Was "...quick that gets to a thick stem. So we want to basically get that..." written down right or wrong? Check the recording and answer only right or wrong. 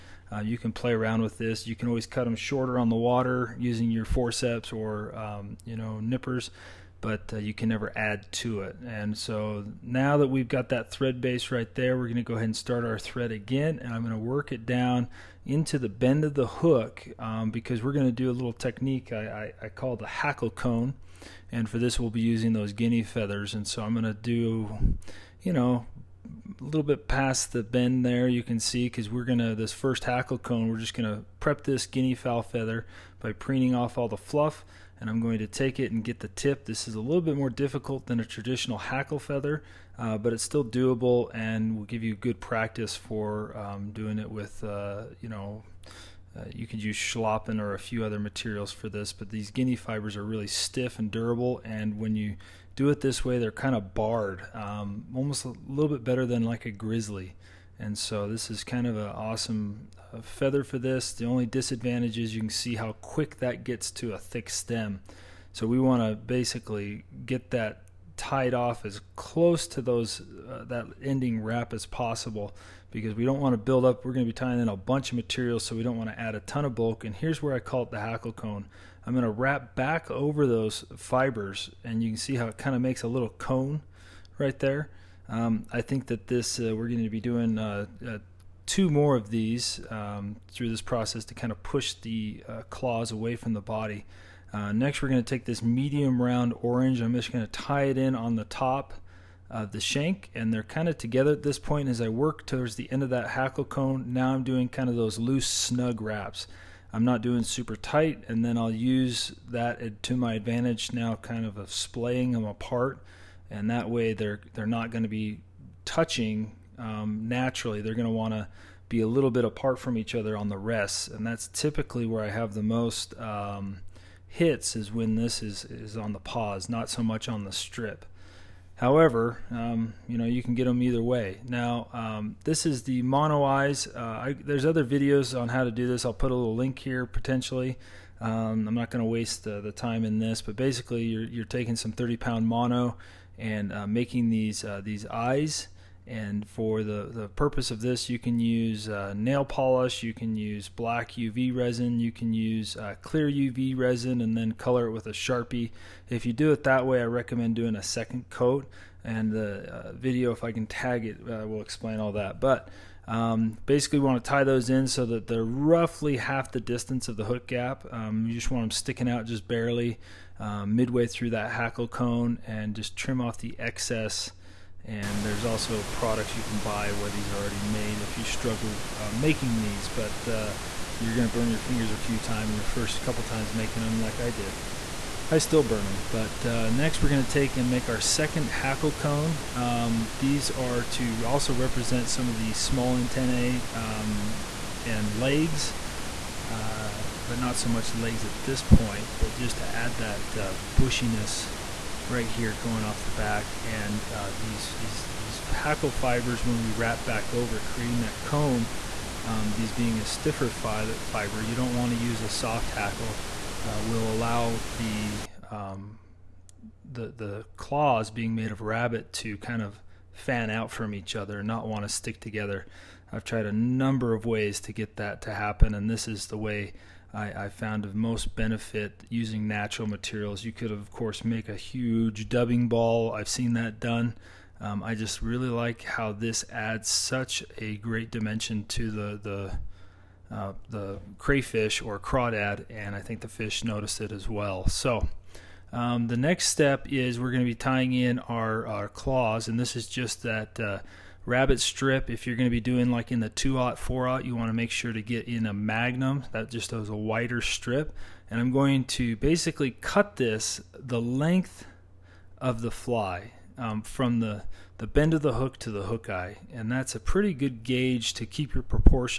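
right.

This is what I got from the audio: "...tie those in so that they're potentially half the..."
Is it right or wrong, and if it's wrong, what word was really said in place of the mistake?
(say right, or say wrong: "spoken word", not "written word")
wrong: "roughly", not "potentially".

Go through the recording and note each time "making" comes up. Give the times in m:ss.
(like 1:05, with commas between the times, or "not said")
2:23, 2:59, 3:03.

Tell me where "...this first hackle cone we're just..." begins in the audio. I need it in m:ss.
0:29.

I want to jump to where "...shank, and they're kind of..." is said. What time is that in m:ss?
1:39.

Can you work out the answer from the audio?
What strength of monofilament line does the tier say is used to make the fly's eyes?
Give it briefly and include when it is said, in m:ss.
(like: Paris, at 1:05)
30 pound, at 2:21.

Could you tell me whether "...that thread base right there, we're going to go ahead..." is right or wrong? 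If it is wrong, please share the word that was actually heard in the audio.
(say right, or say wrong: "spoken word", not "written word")
right.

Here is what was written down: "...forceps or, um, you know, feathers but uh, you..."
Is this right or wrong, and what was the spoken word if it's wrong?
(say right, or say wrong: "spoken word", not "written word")
wrong: "nippers", not "feathers".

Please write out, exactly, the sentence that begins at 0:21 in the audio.
And for this, we'll be using those guinea feathers.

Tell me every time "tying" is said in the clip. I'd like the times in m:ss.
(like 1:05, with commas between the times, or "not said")
1:14, 4:07.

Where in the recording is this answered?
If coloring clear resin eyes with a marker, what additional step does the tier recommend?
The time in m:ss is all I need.
2:37.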